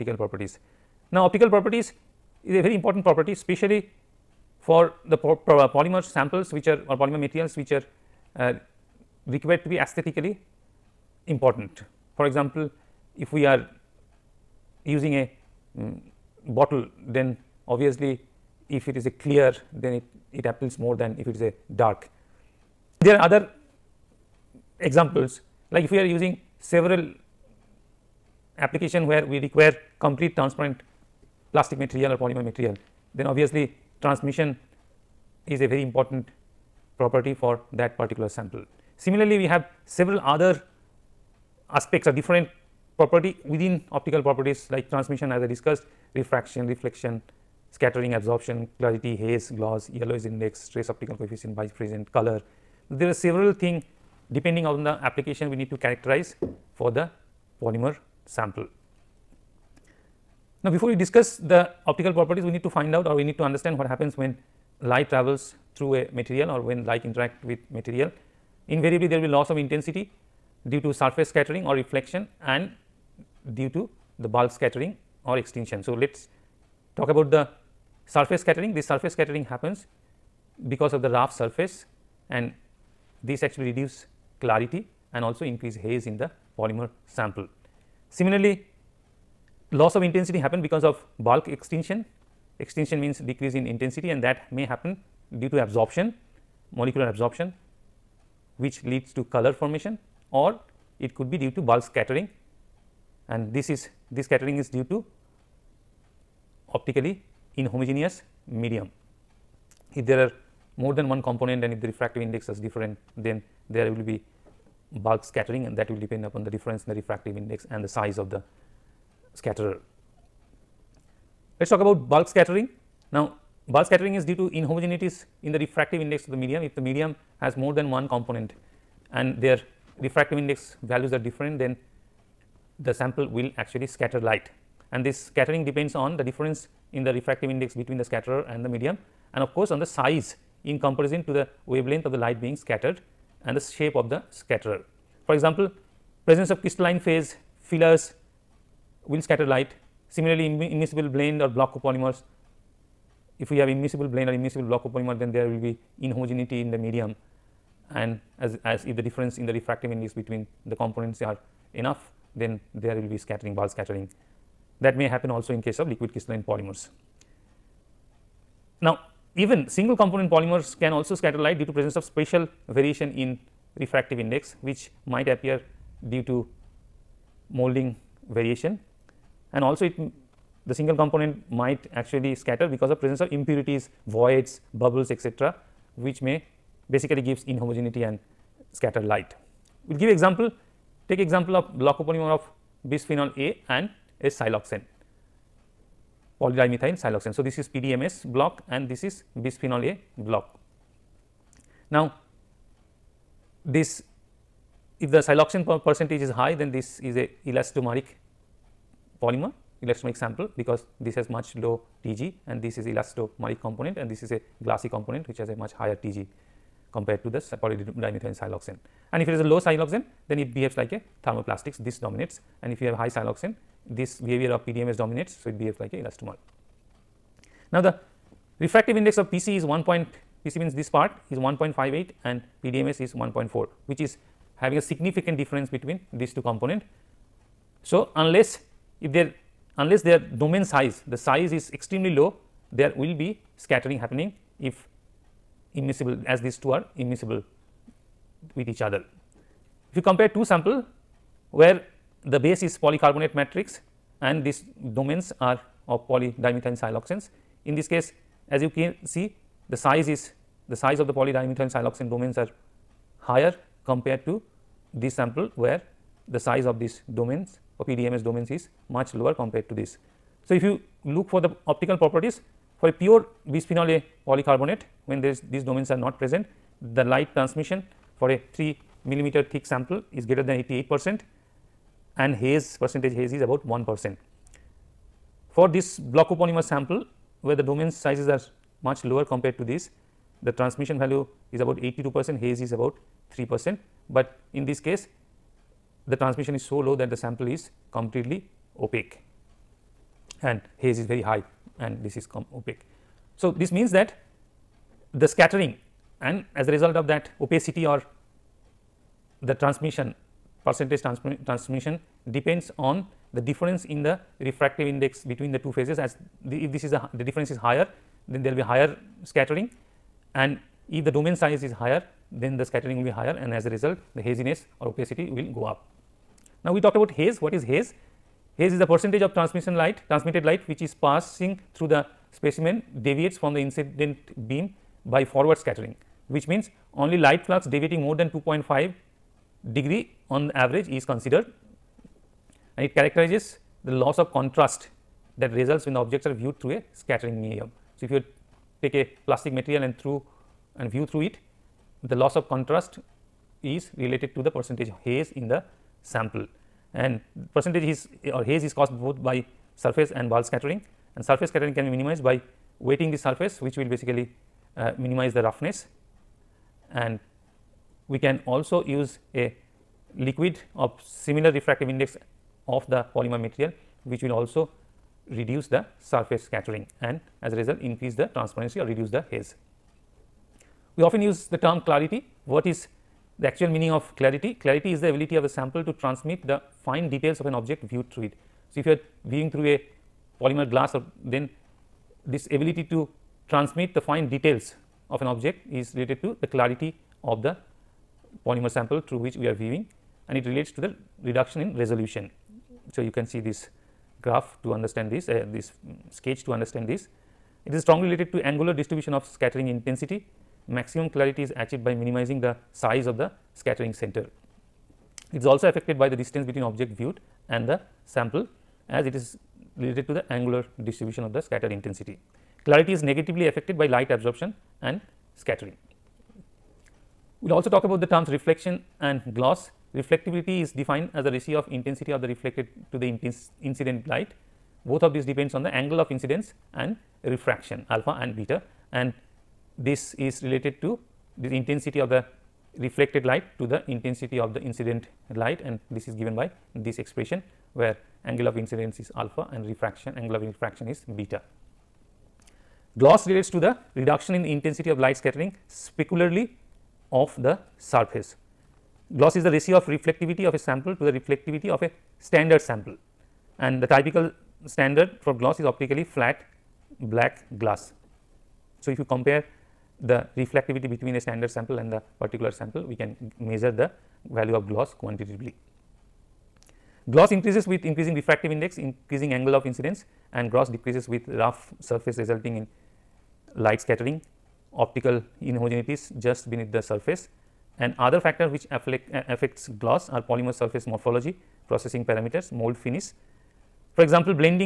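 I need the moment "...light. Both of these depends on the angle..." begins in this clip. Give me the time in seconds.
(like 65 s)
434 s.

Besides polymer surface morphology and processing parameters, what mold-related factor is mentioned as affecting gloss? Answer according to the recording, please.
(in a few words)
Mold finish.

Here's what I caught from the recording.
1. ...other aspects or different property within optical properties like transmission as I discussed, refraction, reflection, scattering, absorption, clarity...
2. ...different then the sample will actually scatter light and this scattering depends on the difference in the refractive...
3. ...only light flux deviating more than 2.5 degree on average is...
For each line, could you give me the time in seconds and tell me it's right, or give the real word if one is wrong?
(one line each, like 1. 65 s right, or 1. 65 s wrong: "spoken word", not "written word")
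1. 40 s right
2. 131 s right
3. 337 s right.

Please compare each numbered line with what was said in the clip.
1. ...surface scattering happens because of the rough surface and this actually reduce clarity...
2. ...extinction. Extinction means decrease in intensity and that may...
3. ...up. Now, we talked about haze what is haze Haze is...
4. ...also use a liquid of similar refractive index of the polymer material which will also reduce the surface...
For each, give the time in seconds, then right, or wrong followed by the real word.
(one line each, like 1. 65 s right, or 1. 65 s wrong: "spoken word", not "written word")
1. 78 s right
2. 91 s right
3. 325 s right
4. 368 s right.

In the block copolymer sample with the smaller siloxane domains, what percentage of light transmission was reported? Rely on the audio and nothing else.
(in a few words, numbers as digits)
82 percent.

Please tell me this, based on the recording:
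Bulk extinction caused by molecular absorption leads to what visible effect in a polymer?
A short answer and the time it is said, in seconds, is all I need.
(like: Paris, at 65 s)
Color formation, at 99 s.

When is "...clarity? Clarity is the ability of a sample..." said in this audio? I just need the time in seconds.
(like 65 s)
384 s.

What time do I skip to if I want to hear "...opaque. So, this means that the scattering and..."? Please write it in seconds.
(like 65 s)
302 s.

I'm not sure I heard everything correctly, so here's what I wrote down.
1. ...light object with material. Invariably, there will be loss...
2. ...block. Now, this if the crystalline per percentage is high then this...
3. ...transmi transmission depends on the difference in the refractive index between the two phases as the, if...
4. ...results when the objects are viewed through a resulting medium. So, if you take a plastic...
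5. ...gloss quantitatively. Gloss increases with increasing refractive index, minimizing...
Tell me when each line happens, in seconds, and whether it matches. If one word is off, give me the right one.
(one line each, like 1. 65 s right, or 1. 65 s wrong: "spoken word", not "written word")
1. 66 s wrong: "interact", not "object"
2. 200 s wrong: "siloxane", not "crystalline"
3. 311 s right
4. 345 s wrong: "scattering", not "resulting"
5. 474 s wrong: "increasing", not "minimizing".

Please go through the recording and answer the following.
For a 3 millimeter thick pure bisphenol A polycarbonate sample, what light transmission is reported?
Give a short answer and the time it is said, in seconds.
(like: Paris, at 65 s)
Greater than 88 percent, at 280 s.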